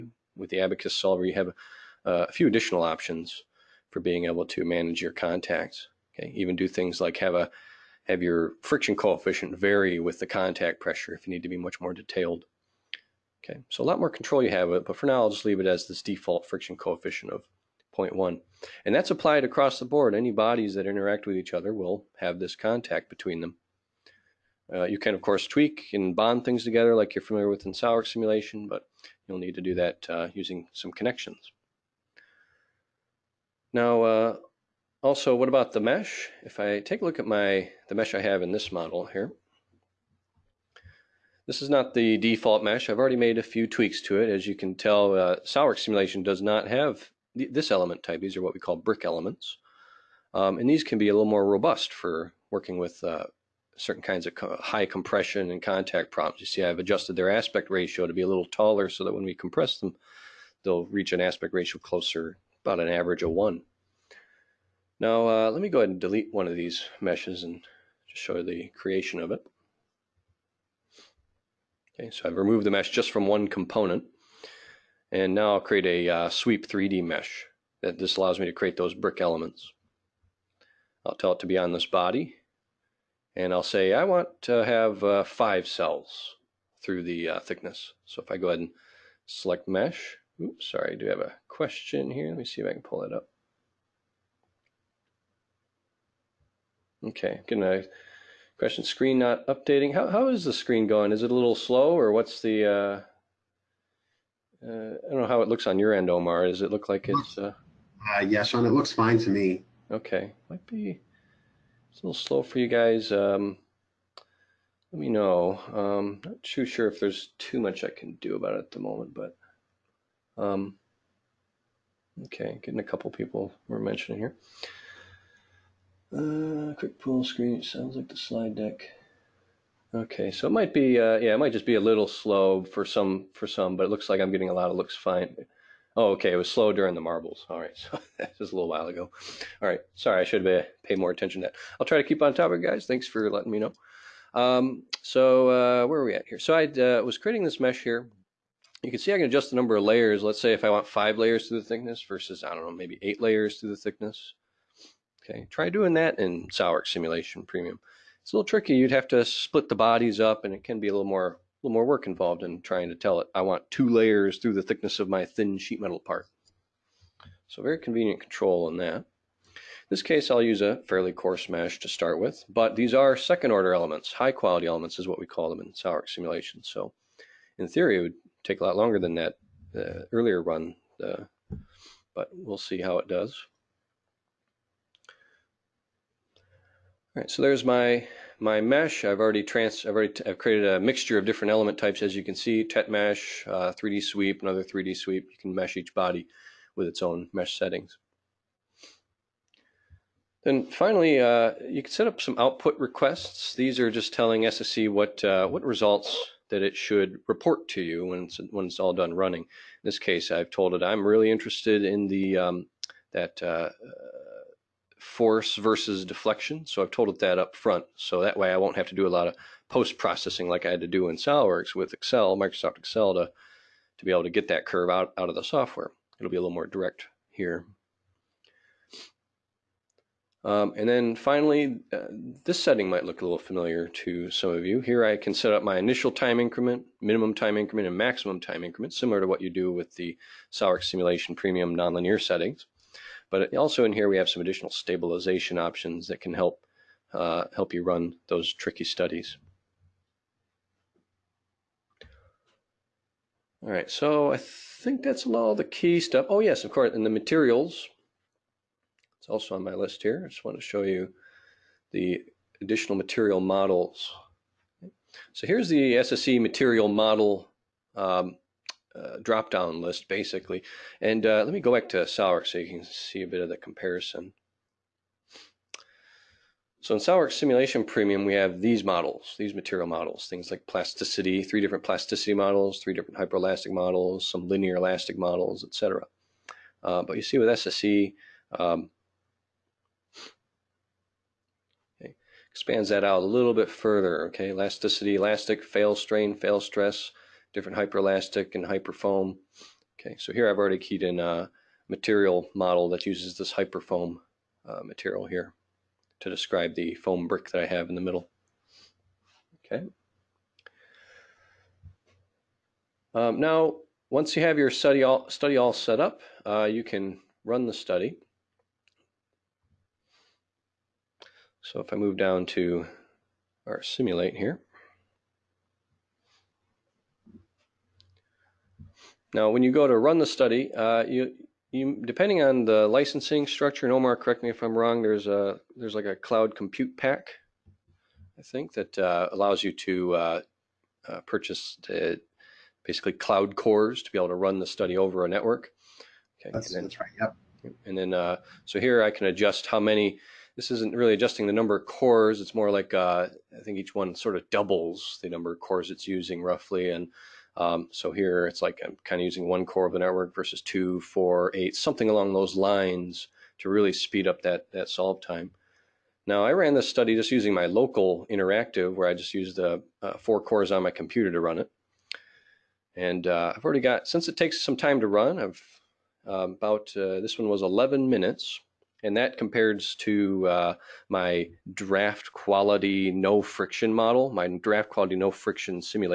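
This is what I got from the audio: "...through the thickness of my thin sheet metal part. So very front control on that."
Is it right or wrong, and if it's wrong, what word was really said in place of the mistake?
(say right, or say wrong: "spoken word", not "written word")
wrong: "convenient", not "front".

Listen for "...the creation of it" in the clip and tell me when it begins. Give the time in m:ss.
1:08.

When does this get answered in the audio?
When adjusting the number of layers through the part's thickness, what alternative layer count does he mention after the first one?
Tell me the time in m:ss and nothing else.
2:33.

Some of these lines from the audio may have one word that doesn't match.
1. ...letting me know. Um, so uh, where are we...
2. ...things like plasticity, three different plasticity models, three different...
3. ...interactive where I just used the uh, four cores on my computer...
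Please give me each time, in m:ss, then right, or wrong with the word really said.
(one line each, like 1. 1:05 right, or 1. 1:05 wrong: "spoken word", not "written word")
1. 2:23 right
2. 4:40 right
3. 6:08 right.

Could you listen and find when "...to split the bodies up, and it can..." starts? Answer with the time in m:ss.
2:39.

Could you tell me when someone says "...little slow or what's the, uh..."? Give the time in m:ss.
1:41.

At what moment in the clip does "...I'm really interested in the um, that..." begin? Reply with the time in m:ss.
3:30.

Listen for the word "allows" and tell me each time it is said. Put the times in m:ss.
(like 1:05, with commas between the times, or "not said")
1:18, 5:39.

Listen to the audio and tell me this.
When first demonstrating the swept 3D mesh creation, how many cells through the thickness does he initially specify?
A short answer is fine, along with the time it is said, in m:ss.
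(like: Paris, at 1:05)
5, at 1:25.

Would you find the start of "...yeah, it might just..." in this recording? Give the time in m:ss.
2:11.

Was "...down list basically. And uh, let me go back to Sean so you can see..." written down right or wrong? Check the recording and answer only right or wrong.
wrong.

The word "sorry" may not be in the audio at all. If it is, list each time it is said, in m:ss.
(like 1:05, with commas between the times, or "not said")
1:30, 2:19.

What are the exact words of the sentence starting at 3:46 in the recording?
It'll be a little more direct here.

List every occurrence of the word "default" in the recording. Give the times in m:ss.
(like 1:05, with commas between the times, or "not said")
0:16, 0:42.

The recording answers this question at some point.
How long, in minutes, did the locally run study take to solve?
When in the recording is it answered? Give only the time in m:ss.
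6:17.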